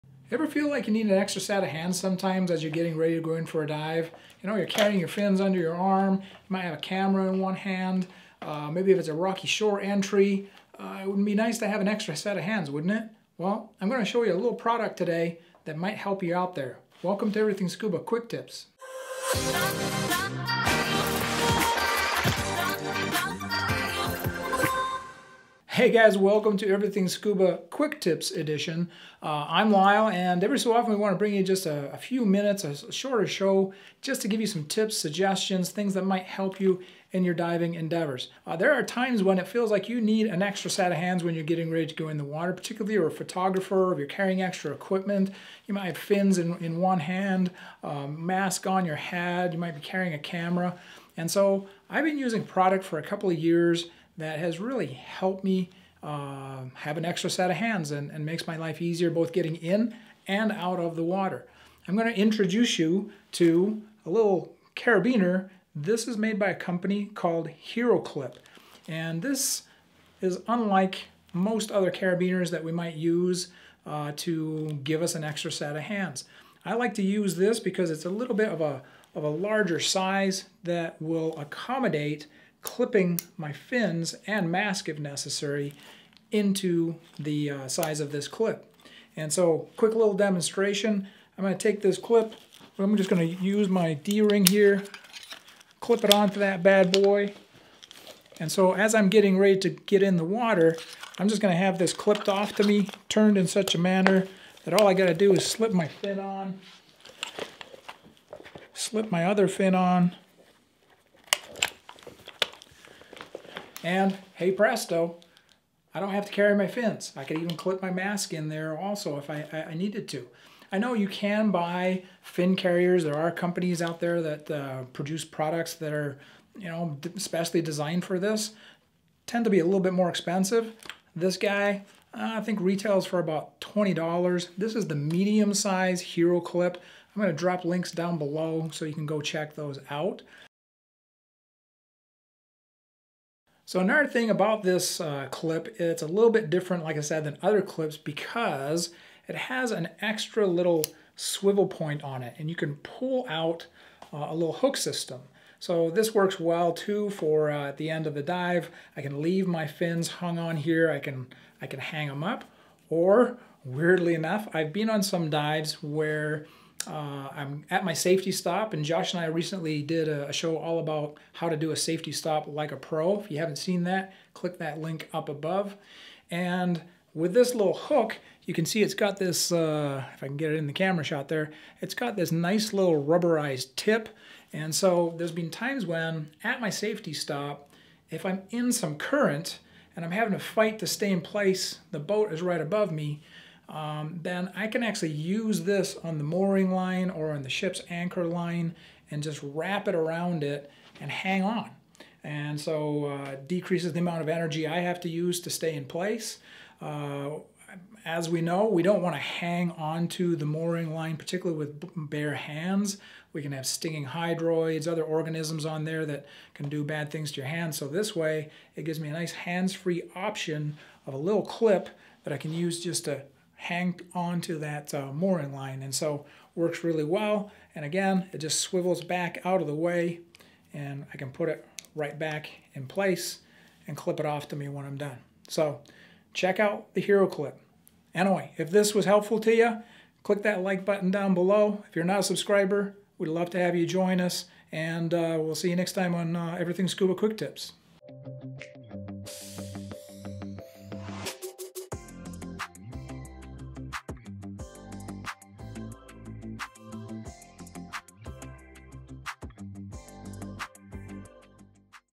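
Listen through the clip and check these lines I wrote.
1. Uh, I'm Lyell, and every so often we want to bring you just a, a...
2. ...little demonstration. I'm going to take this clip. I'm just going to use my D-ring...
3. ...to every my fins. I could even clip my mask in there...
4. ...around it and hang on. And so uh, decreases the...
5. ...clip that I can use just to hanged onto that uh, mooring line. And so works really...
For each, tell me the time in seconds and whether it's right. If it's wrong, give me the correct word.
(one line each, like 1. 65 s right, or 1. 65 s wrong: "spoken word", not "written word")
1. 29 s right
2. 89 s right
3. 116 s wrong: "carry", not "every"
4. 199 s right
5. 221 s right.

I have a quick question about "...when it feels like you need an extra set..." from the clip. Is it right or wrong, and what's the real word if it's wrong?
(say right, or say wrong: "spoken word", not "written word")
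right.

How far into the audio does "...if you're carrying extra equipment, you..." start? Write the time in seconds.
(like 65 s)
43 s.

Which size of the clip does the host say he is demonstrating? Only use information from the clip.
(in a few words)
Medium.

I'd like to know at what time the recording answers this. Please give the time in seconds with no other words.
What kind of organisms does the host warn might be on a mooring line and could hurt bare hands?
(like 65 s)
213 s.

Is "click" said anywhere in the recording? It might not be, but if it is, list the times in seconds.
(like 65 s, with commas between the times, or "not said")
174 s, 240 s.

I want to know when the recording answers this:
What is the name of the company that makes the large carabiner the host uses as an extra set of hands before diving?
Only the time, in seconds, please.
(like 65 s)
67 s.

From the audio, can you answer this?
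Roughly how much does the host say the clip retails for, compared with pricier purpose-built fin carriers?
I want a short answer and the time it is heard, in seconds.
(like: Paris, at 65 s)
$20, at 133 s.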